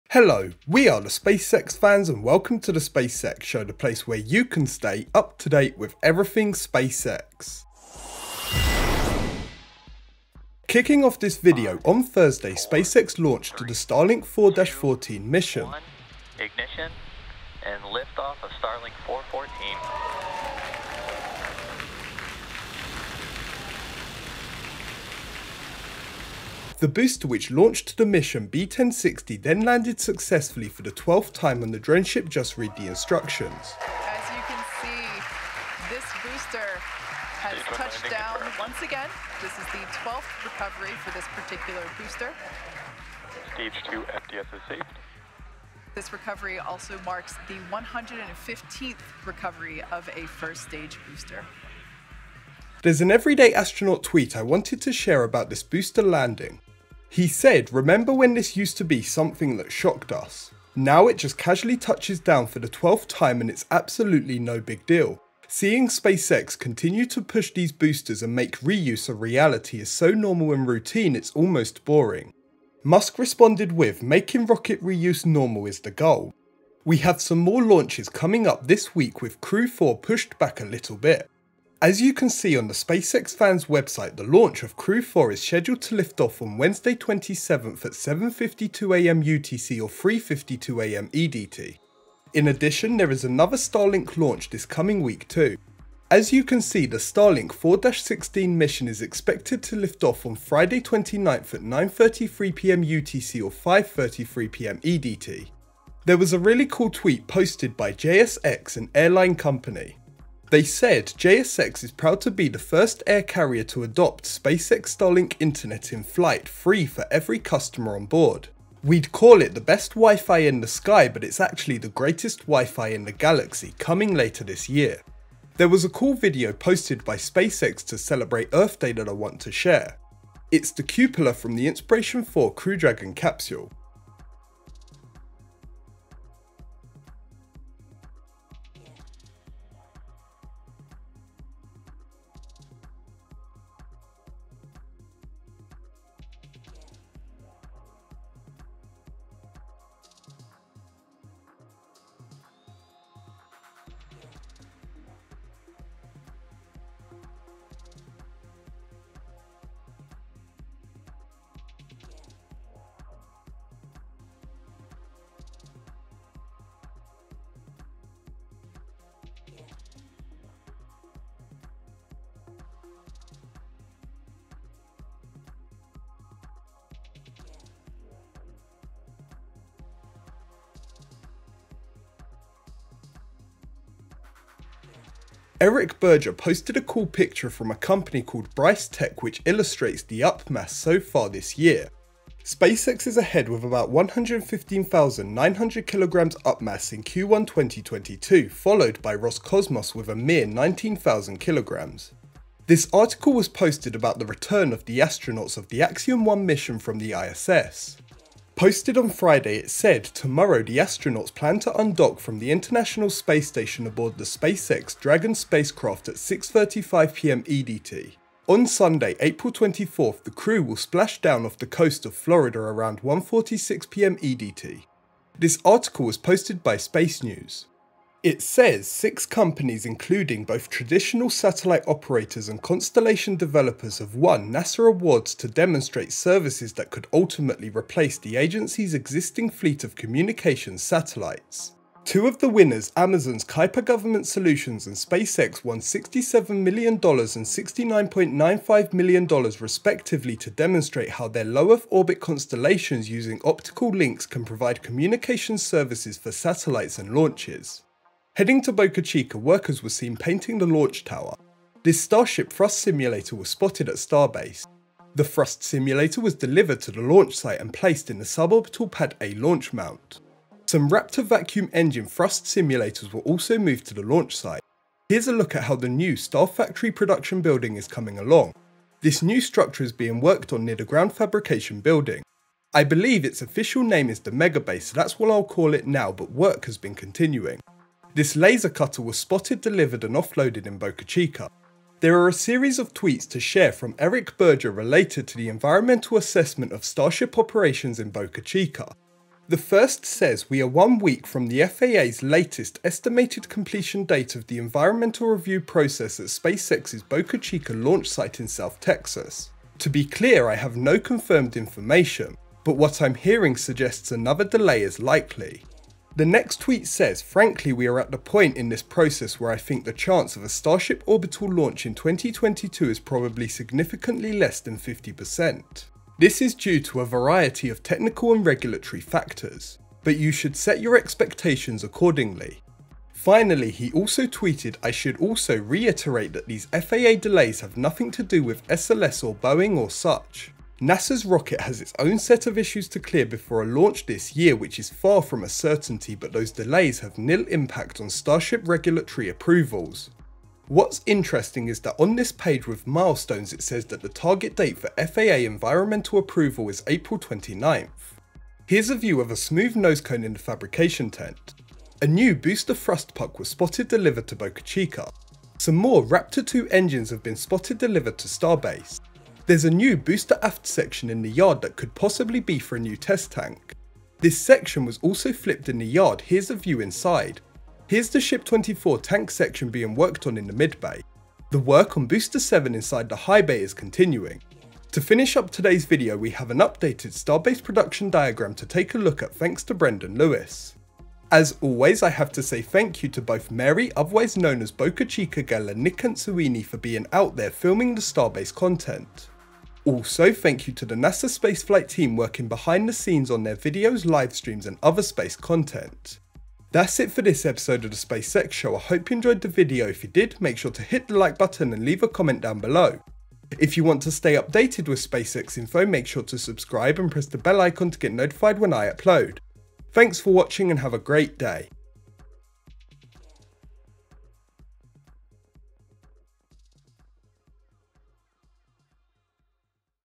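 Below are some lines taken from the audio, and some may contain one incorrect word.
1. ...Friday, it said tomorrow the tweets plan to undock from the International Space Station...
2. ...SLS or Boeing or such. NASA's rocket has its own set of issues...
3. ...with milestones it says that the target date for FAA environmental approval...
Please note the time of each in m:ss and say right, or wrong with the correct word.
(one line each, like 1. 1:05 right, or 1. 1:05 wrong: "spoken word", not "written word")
1. 3:29 wrong: "astronauts", not "tweets"
2. 5:38 right
3. 5:52 right.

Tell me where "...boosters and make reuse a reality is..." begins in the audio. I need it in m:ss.
1:07.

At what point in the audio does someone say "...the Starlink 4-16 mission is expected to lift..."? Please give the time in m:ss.
1:36.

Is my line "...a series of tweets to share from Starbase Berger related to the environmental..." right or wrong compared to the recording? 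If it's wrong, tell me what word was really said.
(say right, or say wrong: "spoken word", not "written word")
wrong: "Eric", not "Starbase".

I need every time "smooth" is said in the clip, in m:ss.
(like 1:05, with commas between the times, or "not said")
5:59.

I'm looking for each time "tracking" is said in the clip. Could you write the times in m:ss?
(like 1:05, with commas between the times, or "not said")
not said.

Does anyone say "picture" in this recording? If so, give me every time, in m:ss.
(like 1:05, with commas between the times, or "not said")
3:07.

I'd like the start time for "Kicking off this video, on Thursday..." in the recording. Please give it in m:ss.
0:10.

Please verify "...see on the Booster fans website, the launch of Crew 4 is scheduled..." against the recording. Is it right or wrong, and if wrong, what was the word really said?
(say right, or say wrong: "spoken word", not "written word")
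wrong: "SpaceX", not "Booster".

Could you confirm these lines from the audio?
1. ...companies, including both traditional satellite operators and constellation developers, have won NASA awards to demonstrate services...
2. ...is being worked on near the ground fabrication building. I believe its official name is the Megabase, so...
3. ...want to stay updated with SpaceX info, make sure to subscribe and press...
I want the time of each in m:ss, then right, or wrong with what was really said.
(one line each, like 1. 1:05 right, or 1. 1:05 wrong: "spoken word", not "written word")
1. 3:49 right
2. 4:39 right
3. 6:53 right.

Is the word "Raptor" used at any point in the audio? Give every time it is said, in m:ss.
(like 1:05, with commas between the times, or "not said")
4:30, 6:06.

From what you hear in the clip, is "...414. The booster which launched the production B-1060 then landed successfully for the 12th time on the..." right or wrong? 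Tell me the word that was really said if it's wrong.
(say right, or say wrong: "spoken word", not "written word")
wrong: "mission", not "production".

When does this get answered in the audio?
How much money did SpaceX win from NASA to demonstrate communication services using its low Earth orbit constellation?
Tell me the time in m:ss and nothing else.
4:07.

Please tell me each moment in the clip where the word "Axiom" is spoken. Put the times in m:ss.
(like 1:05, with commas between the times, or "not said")
3:25.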